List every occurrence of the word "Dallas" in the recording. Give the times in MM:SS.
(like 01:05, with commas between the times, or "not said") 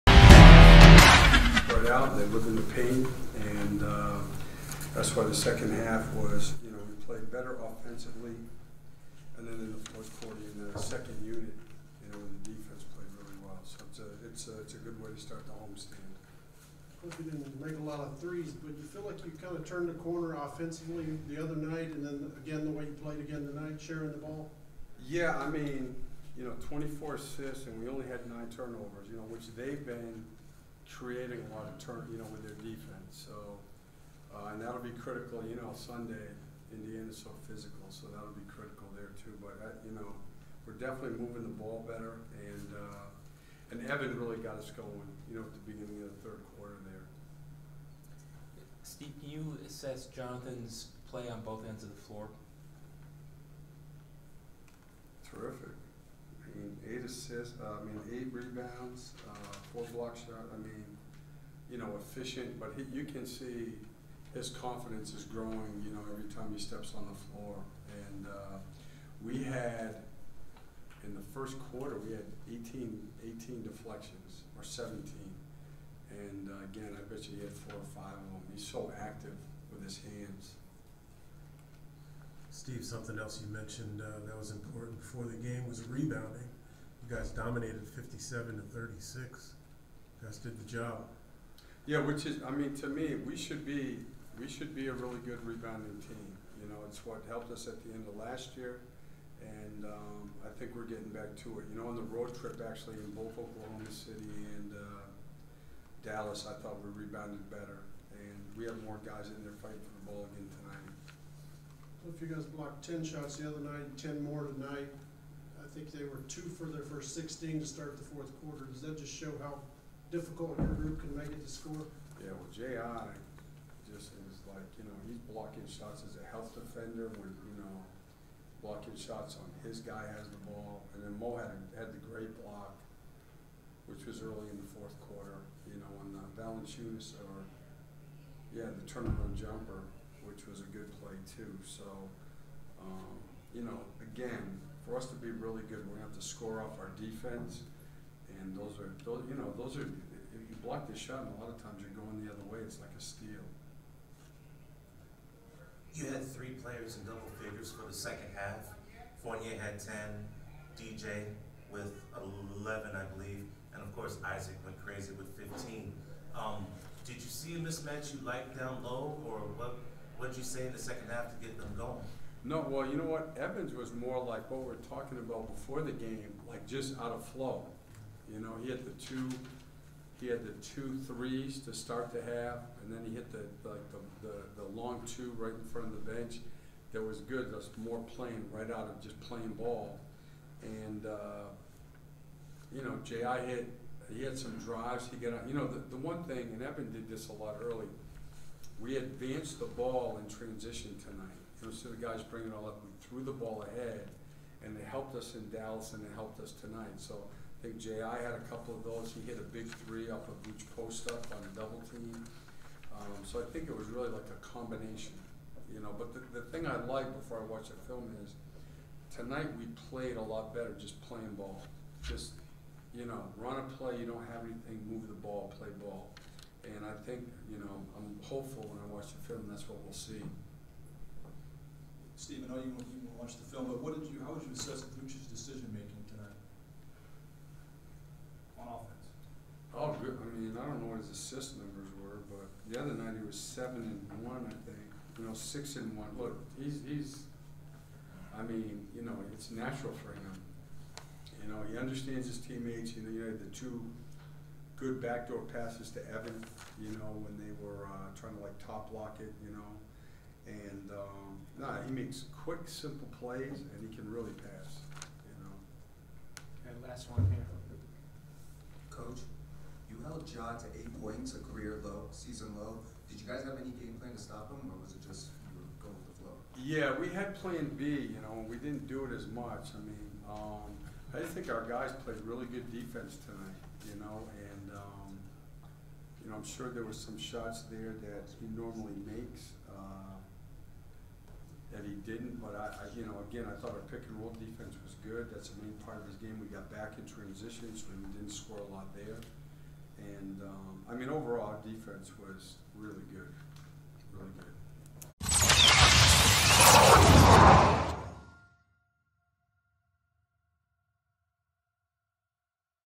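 01:46, 03:25.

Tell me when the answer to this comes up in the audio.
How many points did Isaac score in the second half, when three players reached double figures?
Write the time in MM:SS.
02:45.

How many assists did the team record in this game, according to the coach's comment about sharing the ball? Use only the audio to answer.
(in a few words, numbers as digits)
24.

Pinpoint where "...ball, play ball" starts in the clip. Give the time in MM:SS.
03:45.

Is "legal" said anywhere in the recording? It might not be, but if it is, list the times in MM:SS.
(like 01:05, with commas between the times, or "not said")
not said.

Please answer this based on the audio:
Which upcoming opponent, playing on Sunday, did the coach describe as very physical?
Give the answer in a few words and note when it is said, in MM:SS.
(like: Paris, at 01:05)
Indiana, at 00:36.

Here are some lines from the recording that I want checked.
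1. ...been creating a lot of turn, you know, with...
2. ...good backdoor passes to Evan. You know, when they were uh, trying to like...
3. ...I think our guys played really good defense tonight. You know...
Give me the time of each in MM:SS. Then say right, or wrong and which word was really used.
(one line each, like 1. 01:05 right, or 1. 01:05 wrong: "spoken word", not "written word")
1. 00:29 right
2. 04:14 right
3. 04:41 right.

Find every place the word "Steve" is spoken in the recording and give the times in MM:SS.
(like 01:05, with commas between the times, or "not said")
00:48, 01:22, 03:52.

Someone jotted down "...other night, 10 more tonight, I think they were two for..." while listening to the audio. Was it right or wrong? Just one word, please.
right.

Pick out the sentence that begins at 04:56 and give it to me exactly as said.
We got back in transition, so we didn't score a lot there.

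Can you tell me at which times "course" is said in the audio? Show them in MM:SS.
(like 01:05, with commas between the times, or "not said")
00:17, 02:43.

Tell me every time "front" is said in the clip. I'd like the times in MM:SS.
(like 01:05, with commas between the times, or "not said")
03:05.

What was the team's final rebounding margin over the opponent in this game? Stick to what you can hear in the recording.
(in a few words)
57 to 36.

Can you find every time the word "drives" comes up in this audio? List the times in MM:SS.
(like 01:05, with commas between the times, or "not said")
03:14.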